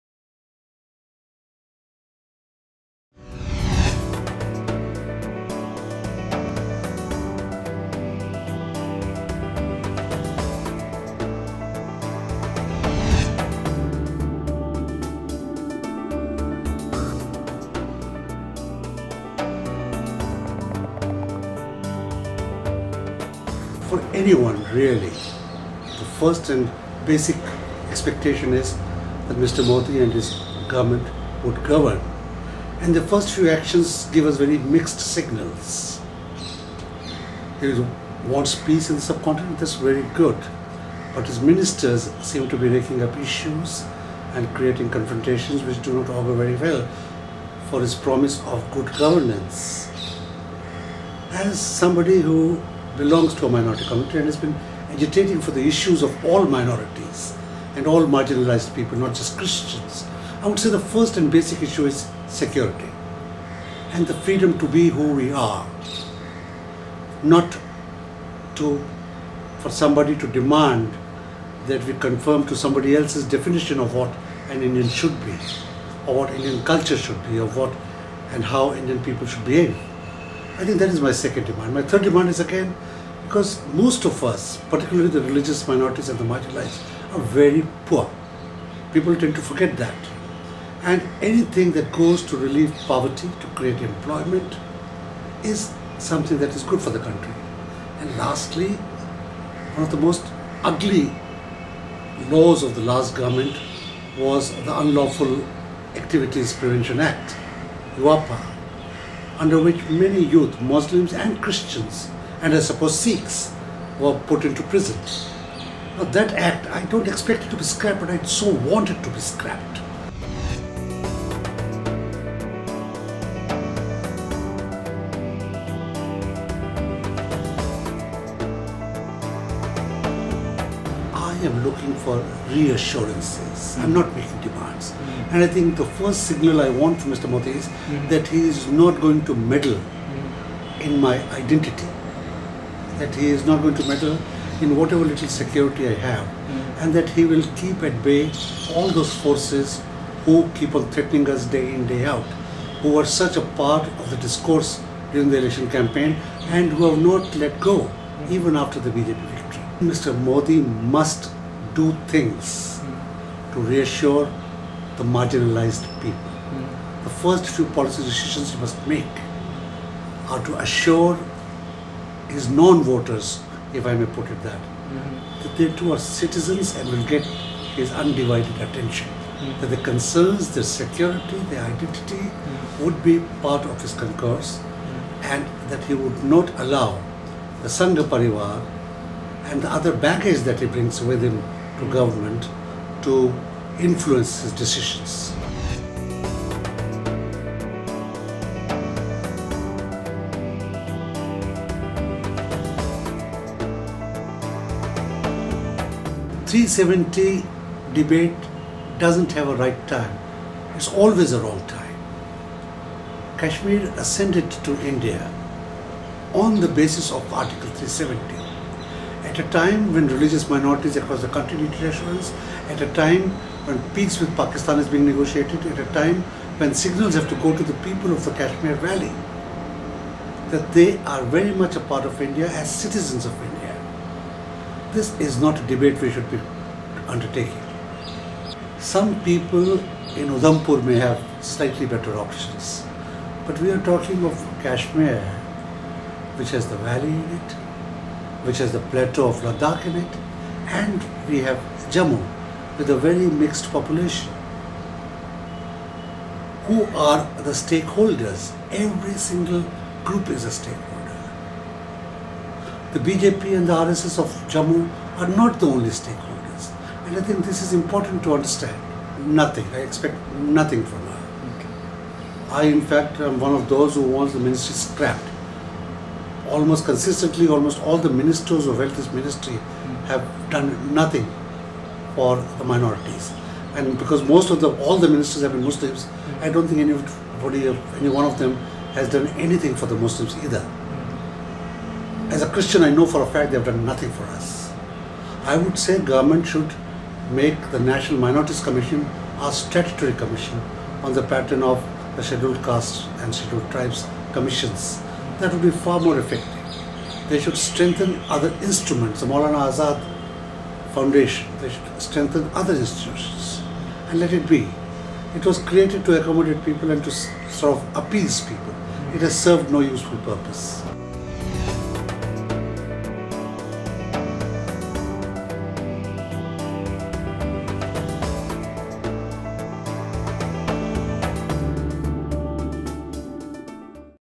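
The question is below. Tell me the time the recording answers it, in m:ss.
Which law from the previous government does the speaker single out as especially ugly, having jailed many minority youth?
1:44.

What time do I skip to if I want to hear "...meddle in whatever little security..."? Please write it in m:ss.
2:23.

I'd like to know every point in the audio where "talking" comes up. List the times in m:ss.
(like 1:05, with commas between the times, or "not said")
4:03.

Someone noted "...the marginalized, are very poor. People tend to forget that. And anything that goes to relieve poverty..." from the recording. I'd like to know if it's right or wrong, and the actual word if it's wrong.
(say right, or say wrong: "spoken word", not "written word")
right.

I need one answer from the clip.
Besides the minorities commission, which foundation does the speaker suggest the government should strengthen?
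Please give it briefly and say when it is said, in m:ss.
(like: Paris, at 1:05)
Maulana Azad Foundation, at 5:09.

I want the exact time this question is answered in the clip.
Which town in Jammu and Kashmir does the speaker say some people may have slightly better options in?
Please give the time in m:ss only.
4:00.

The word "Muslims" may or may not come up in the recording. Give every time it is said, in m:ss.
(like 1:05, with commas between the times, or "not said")
1:50, 4:45, 4:49.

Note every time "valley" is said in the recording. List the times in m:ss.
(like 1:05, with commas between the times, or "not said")
3:48, 4:06.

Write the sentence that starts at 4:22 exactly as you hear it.
The BJP and the RSS of Jammu are not the only stakeholders.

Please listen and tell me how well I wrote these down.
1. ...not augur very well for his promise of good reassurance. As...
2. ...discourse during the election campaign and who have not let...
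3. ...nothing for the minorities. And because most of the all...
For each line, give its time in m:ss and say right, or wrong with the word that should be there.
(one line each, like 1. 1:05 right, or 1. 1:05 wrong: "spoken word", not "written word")
1. 0:46 wrong: "governance", not "reassurance"
2. 2:34 right
3. 4:40 right.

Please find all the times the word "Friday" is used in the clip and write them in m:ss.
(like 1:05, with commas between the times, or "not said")
not said.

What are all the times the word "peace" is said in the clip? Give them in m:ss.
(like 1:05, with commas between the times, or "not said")
0:38, 3:43.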